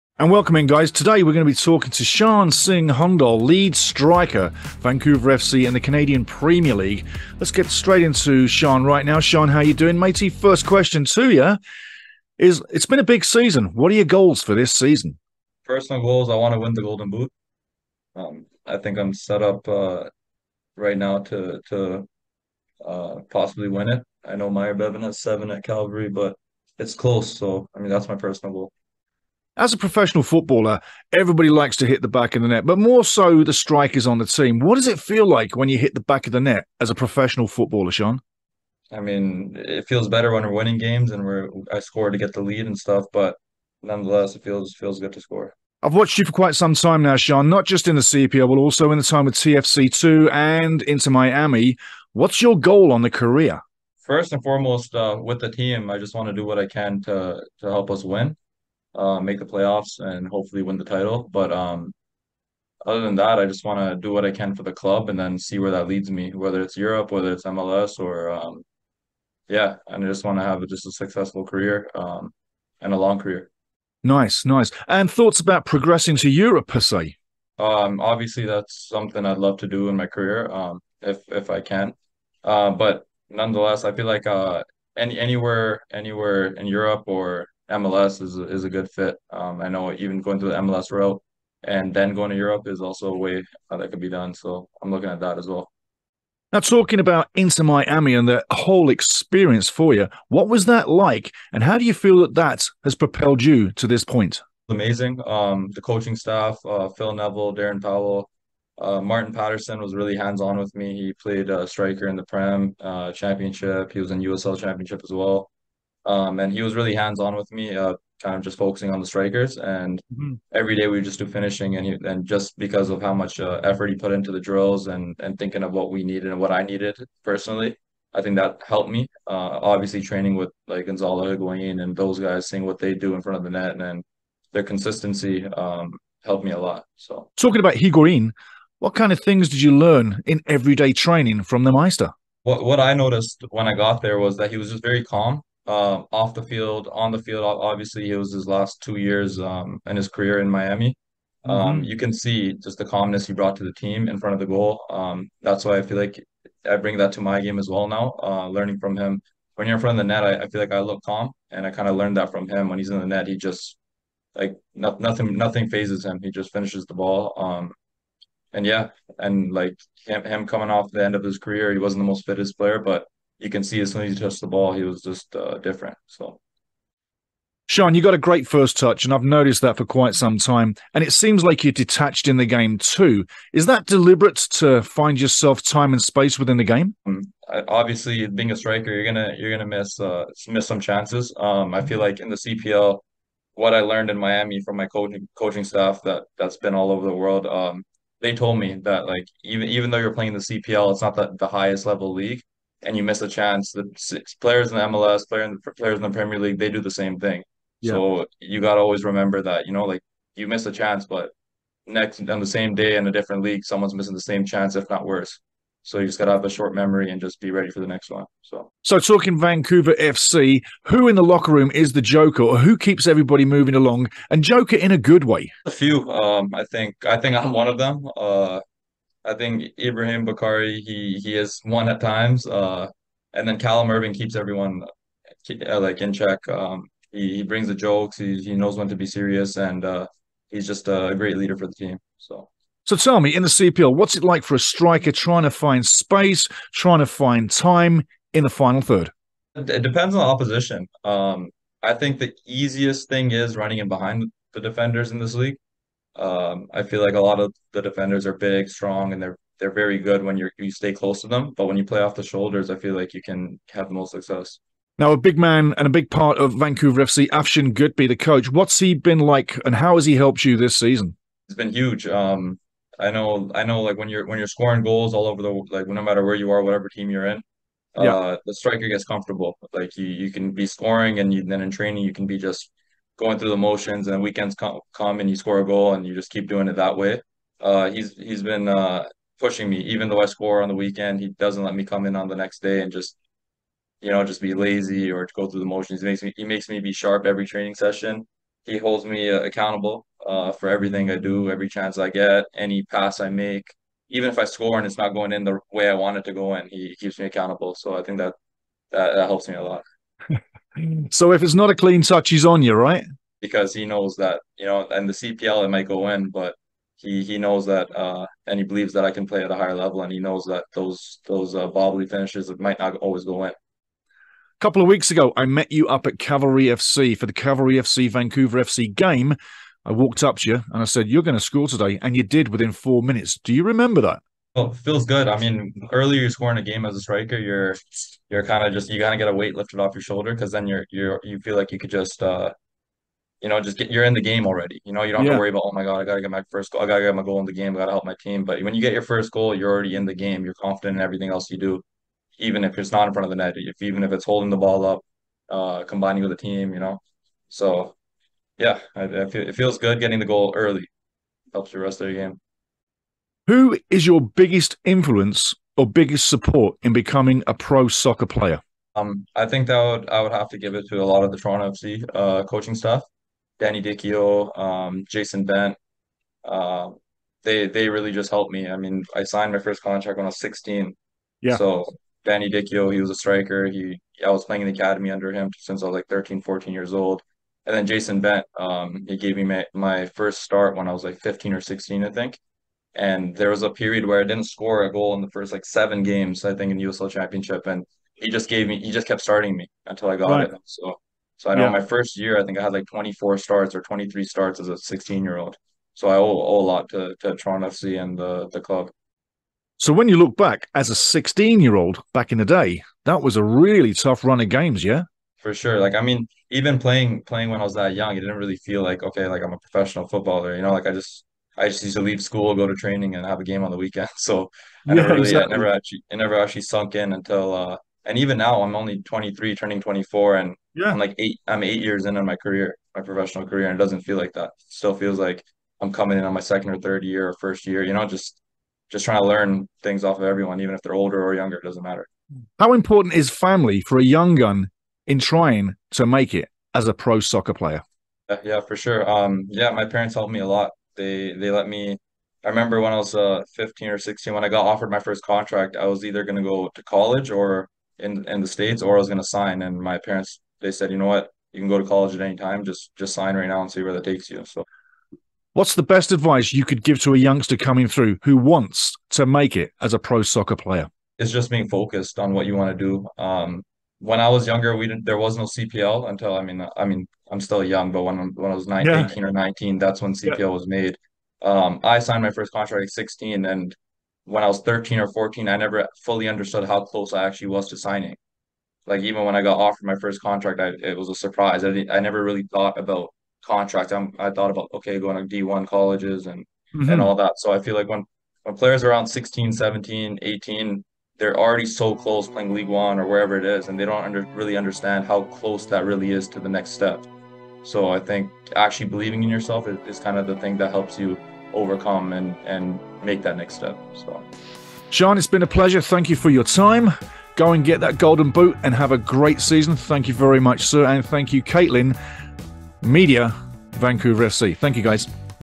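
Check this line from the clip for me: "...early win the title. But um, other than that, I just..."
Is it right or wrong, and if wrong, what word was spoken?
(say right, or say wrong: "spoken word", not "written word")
wrong: "hopefully", not "early".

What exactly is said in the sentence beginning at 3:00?
And it seems like you're detached in the game too.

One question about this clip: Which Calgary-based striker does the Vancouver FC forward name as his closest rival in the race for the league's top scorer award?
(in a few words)
Myer Bevan.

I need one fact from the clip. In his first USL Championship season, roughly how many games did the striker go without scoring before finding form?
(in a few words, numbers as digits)
7.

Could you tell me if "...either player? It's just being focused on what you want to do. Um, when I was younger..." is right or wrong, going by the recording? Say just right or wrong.
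wrong.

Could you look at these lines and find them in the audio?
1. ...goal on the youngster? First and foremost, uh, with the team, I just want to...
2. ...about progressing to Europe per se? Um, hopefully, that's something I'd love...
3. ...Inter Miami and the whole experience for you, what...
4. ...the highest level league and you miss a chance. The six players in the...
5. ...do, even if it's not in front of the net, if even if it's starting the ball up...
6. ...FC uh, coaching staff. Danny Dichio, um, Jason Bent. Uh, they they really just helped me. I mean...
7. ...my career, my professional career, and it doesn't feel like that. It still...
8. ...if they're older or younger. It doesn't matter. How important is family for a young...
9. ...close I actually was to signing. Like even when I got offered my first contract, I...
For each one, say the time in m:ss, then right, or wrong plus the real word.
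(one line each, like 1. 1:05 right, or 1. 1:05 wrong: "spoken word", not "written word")
1. 0:52 wrong: "career", not "youngster"
2. 1:15 wrong: "obviously", not "hopefully"
3. 1:37 right
4. 3:21 right
5. 5:51 wrong: "holding", not "starting"
6. 6:11 right
7. 7:12 right
8. 7:20 right
9. 8:06 right.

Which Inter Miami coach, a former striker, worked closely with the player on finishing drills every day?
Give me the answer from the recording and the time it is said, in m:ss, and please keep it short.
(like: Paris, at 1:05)
Martin Paterson, at 1:48.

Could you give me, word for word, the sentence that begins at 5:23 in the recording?
A couple of weeks ago, I met you up at Cavalry FC for the Cavalry FC Vancouver FC game.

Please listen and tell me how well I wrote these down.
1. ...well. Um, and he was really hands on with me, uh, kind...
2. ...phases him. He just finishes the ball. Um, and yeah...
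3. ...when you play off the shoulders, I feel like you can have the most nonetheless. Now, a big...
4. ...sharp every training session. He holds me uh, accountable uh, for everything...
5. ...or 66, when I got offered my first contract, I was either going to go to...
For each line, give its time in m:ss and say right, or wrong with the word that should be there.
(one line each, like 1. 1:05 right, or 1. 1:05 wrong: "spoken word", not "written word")
1. 1:55 right
2. 2:45 right
3. 4:21 wrong: "success", not "nonetheless"
4. 4:56 right
5. 7:33 wrong: "16", not "66".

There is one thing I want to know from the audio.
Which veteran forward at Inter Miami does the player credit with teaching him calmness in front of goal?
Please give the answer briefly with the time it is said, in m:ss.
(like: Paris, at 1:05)
Gonzalo Higuain, at 2:10.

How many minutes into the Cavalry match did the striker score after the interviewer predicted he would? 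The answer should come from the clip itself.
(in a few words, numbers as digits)
4.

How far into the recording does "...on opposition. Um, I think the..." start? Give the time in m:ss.
4:10.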